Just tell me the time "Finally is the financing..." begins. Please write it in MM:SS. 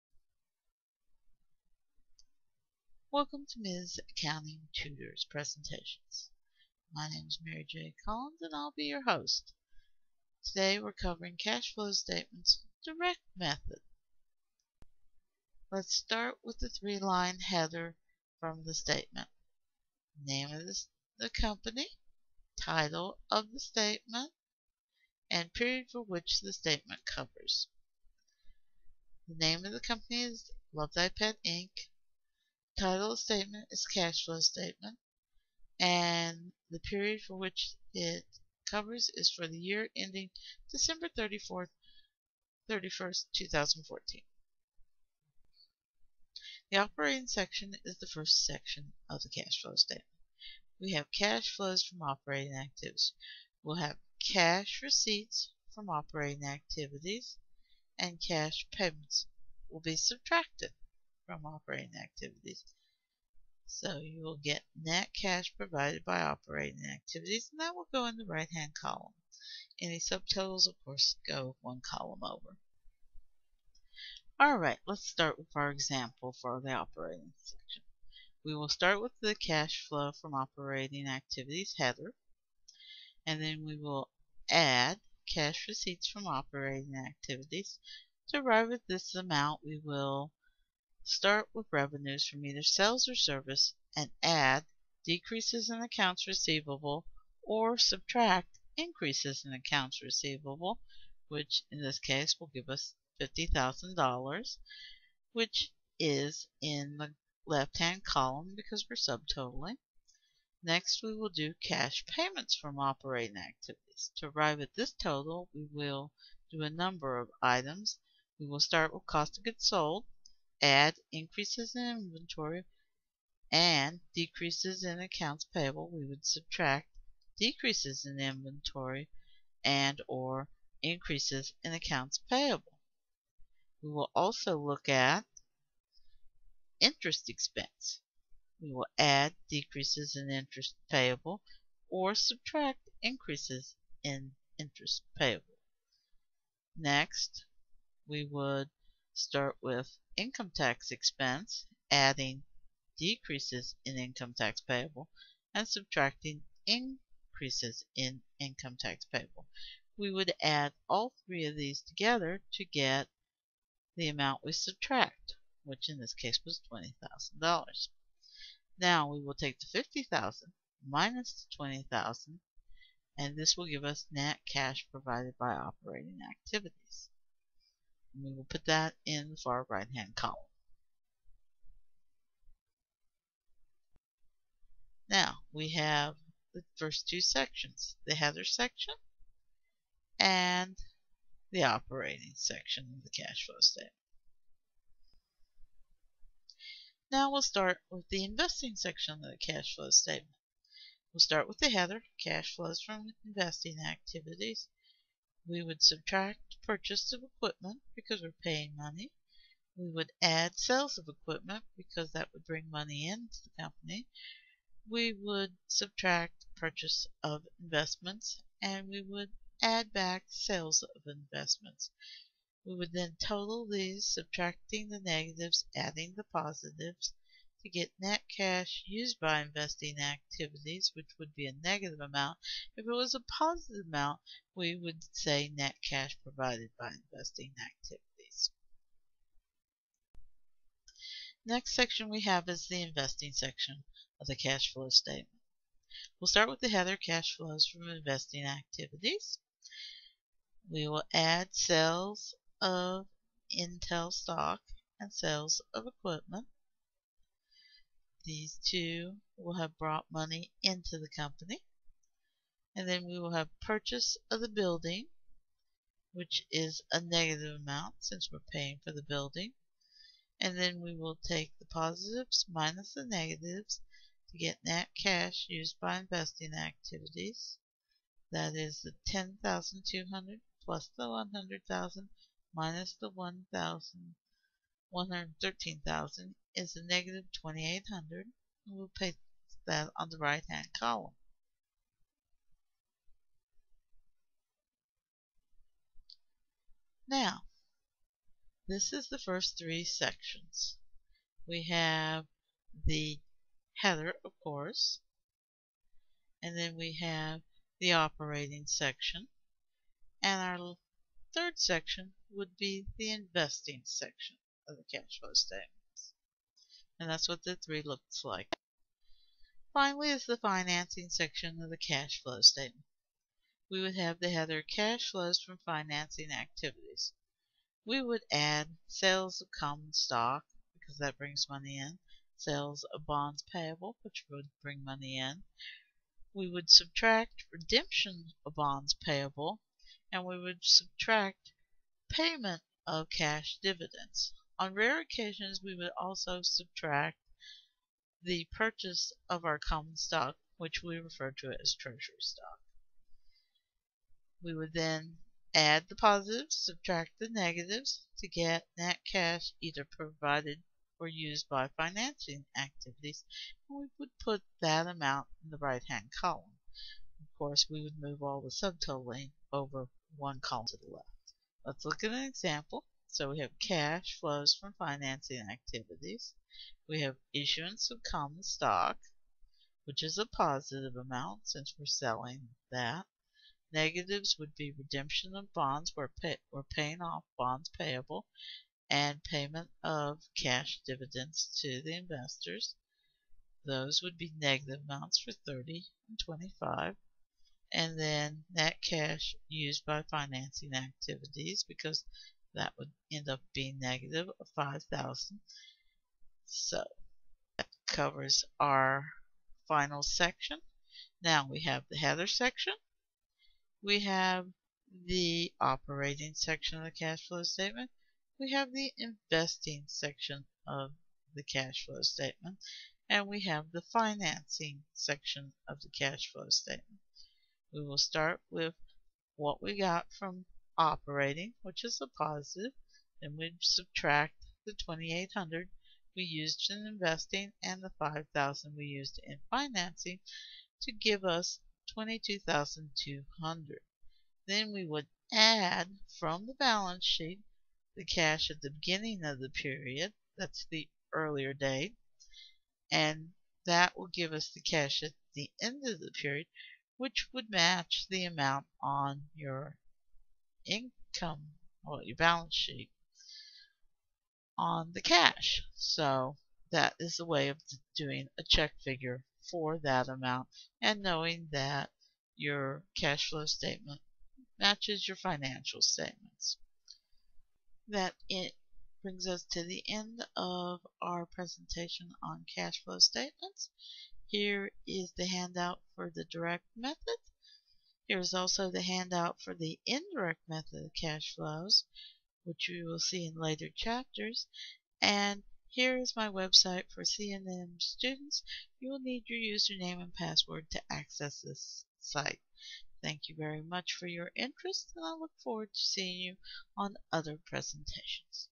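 05:19.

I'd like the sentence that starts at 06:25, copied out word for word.
We're, pay, we're paying off bonds payable and payment of cash dividends to the investors.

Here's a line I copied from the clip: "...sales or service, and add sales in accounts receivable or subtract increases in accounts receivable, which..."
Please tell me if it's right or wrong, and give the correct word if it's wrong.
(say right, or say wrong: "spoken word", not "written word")
wrong: "decreases", not "sales".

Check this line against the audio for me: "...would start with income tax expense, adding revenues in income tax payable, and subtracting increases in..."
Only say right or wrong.
wrong.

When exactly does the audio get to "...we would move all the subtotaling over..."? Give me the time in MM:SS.
06:07.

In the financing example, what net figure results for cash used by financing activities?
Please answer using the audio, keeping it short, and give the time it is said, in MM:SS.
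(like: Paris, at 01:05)
negative 5,000, at 06:43.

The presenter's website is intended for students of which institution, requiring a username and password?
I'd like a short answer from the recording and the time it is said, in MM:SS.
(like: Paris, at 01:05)
CNM, at 08:17.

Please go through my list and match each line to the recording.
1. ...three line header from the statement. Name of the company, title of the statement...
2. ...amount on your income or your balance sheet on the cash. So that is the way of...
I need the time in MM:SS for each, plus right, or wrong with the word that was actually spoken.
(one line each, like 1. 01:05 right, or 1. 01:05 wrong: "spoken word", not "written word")
1. 00:16 right
2. 07:38 right.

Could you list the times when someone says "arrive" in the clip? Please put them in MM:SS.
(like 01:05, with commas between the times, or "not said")
01:28, 01:54.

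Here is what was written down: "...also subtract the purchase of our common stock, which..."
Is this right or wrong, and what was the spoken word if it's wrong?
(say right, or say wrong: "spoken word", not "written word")
right.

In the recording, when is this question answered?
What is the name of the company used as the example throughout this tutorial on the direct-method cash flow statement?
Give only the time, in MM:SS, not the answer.
00:30.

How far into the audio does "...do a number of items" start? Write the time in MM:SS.
01:56.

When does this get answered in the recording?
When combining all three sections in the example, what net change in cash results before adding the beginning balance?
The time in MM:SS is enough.
07:21.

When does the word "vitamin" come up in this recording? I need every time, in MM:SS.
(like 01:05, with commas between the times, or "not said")
not said.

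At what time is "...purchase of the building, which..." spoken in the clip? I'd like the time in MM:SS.
04:23.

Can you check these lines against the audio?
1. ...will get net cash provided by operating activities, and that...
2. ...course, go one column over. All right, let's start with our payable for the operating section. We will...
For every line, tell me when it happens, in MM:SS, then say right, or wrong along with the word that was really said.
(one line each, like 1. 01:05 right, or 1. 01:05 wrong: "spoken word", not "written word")
1. 01:04 right
2. 01:10 wrong: "example", not "payable".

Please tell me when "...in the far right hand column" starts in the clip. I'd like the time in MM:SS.
02:59.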